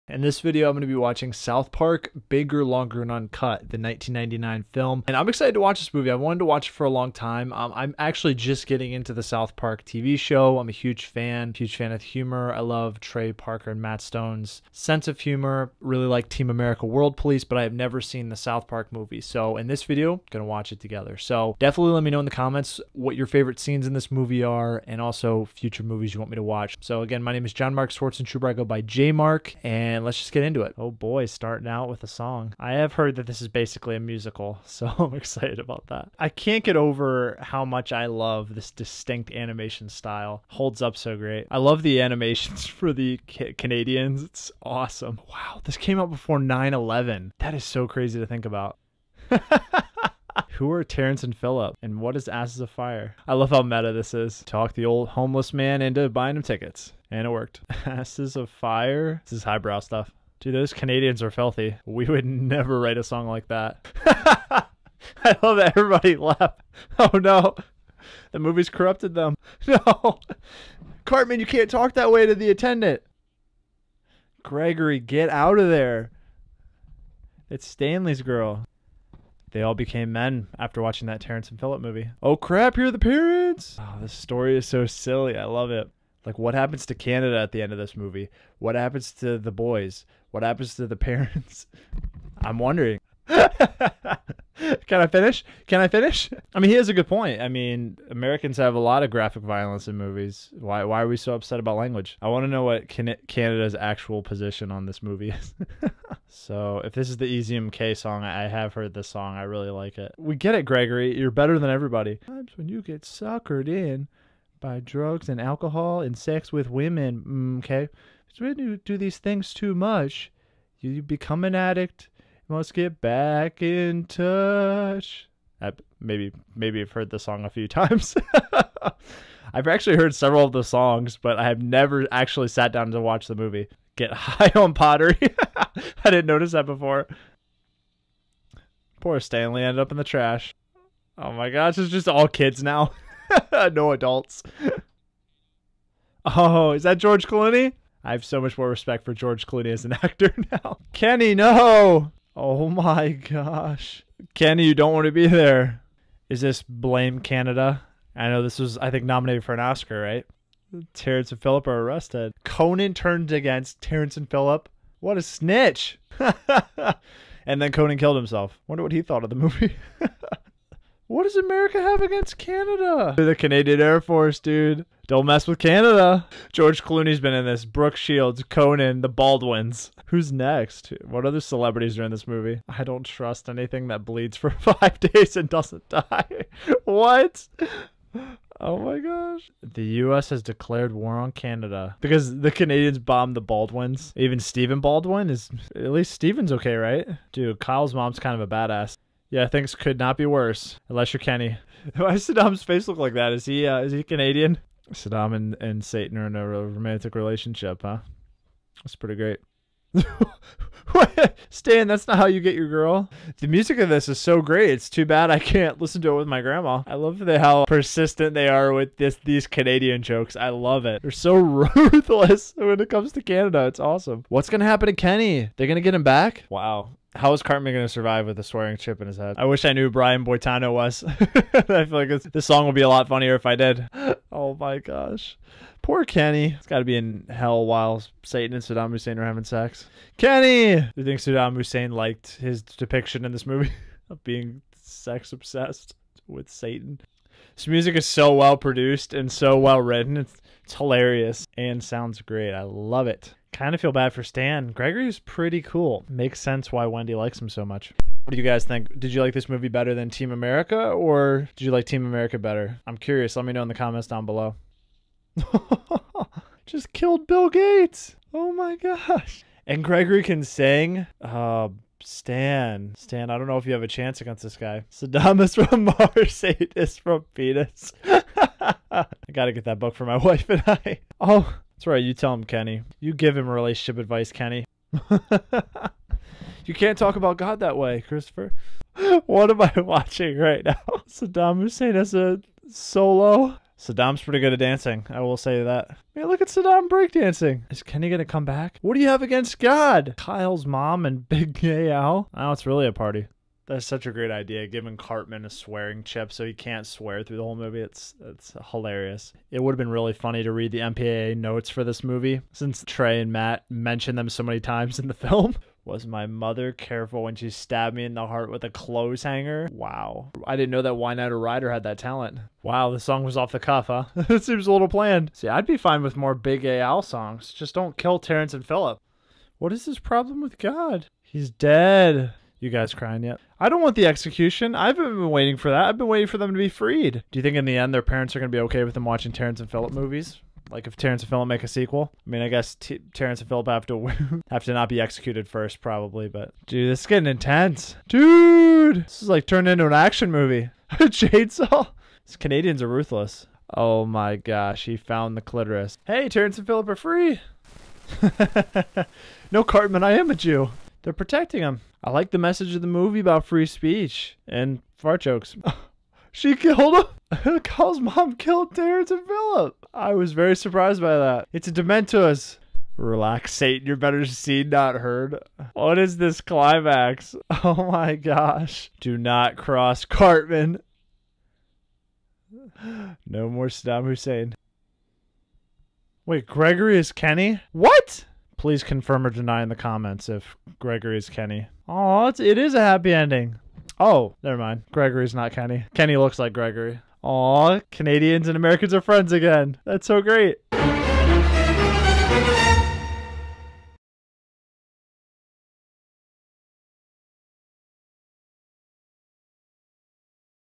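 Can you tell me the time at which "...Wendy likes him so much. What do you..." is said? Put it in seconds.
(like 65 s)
256 s.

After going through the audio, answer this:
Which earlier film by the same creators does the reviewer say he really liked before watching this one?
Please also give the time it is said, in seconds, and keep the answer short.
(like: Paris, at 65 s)
Team America World Police, at 16 s.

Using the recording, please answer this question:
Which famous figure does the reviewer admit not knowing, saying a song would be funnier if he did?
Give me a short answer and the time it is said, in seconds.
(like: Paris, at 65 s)
Brian Boitano, at 229 s.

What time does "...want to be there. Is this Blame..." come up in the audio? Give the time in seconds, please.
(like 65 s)
154 s.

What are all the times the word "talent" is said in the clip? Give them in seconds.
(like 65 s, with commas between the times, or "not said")
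321 s.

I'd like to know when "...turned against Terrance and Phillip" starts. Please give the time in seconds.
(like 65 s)
162 s.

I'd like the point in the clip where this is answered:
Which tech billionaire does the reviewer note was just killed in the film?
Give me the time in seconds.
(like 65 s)
267 s.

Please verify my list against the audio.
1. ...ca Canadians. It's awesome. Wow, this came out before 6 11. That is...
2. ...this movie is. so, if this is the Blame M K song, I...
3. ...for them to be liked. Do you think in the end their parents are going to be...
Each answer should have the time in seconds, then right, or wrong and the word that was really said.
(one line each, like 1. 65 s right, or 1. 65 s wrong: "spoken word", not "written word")
1. 43 s wrong: "9", not "6"
2. 104 s wrong: "Ezium", not "Blame"
3. 336 s wrong: "freed", not "liked".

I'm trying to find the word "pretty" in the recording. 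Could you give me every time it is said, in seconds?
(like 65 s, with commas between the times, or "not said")
208 s, 255 s, 294 s.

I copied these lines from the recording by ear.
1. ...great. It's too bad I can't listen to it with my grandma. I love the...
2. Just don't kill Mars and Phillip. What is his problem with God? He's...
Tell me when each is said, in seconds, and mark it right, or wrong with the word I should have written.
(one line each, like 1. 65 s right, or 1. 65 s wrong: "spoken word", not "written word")
1. 214 s right
2. 327 s wrong: "Terrance", not "Mars".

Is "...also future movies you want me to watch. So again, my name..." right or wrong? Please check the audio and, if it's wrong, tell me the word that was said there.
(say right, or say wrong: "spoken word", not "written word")
right.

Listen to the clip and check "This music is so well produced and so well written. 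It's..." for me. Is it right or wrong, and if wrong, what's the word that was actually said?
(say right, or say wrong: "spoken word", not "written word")
right.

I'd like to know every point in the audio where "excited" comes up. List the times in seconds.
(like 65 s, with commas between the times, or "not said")
5 s, 35 s.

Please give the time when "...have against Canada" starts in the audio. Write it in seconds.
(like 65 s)
171 s.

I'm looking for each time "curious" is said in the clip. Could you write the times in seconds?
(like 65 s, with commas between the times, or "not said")
262 s.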